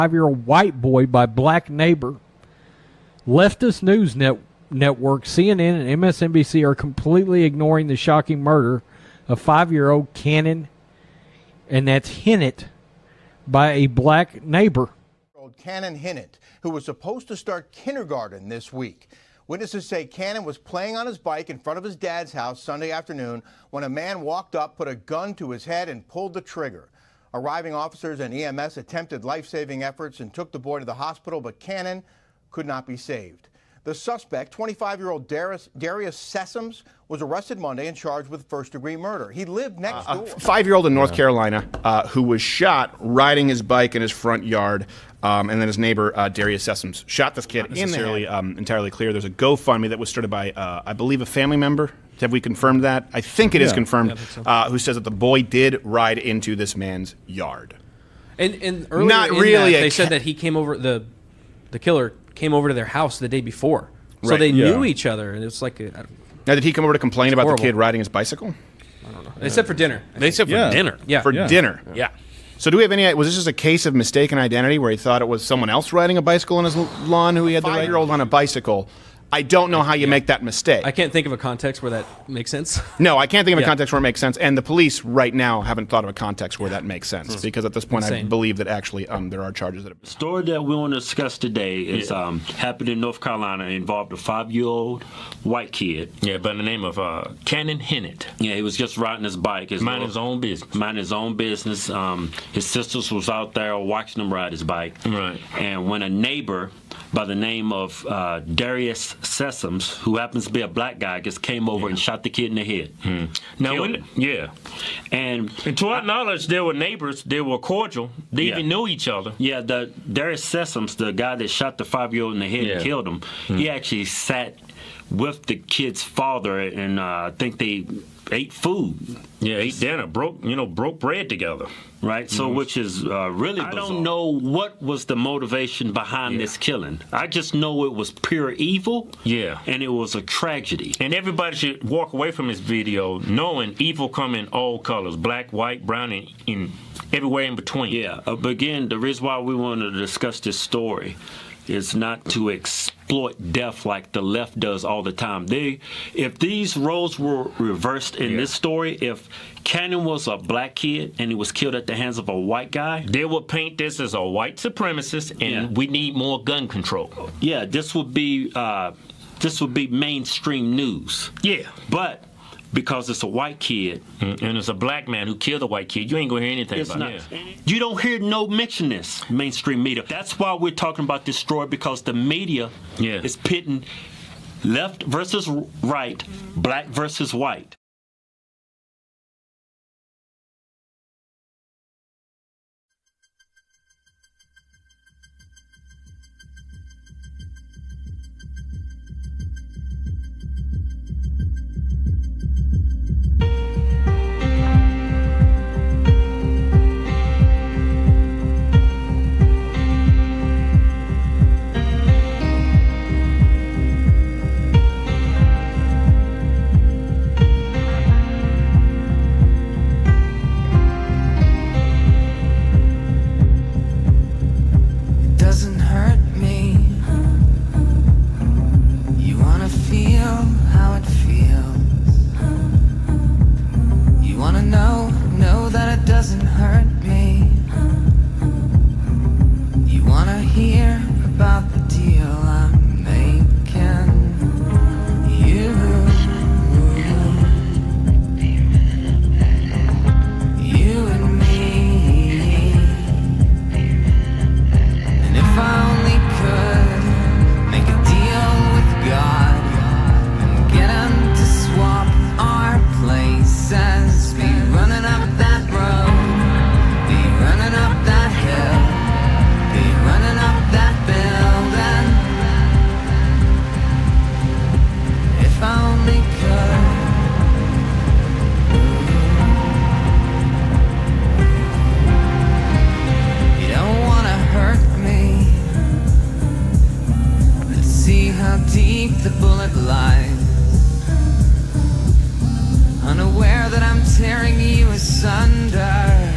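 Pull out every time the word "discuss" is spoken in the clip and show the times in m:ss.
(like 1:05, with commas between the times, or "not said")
1:30, 2:29.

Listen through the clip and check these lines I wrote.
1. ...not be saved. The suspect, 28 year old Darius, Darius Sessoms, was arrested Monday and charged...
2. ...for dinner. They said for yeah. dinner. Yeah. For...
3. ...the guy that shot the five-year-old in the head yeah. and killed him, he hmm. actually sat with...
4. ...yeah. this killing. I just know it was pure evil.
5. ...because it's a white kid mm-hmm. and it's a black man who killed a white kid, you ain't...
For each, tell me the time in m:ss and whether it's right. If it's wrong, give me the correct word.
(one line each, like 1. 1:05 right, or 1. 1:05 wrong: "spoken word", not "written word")
1. 0:32 wrong: "25", not "28"
2. 1:09 right
3. 2:00 right
4. 2:16 right
5. 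2:52 right.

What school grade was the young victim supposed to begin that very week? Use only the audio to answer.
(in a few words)
Kindergarten.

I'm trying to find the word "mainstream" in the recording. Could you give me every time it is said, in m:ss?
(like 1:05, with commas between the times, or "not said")
2:49, 2:59.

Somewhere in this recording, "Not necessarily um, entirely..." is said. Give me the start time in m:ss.
0:47.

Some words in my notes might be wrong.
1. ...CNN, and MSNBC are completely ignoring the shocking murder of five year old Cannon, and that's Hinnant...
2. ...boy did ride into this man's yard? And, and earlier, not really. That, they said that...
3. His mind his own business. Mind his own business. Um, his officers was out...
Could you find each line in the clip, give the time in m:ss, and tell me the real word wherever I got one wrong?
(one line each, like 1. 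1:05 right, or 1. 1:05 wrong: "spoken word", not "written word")
1. 0:05 right
2. 0:55 right
3. 1:39 wrong: "sisters", not "officers".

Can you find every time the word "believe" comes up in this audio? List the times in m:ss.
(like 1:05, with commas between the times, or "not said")
0:50, 1:28.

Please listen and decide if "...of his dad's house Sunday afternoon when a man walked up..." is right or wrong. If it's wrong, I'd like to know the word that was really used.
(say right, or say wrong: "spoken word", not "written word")
right.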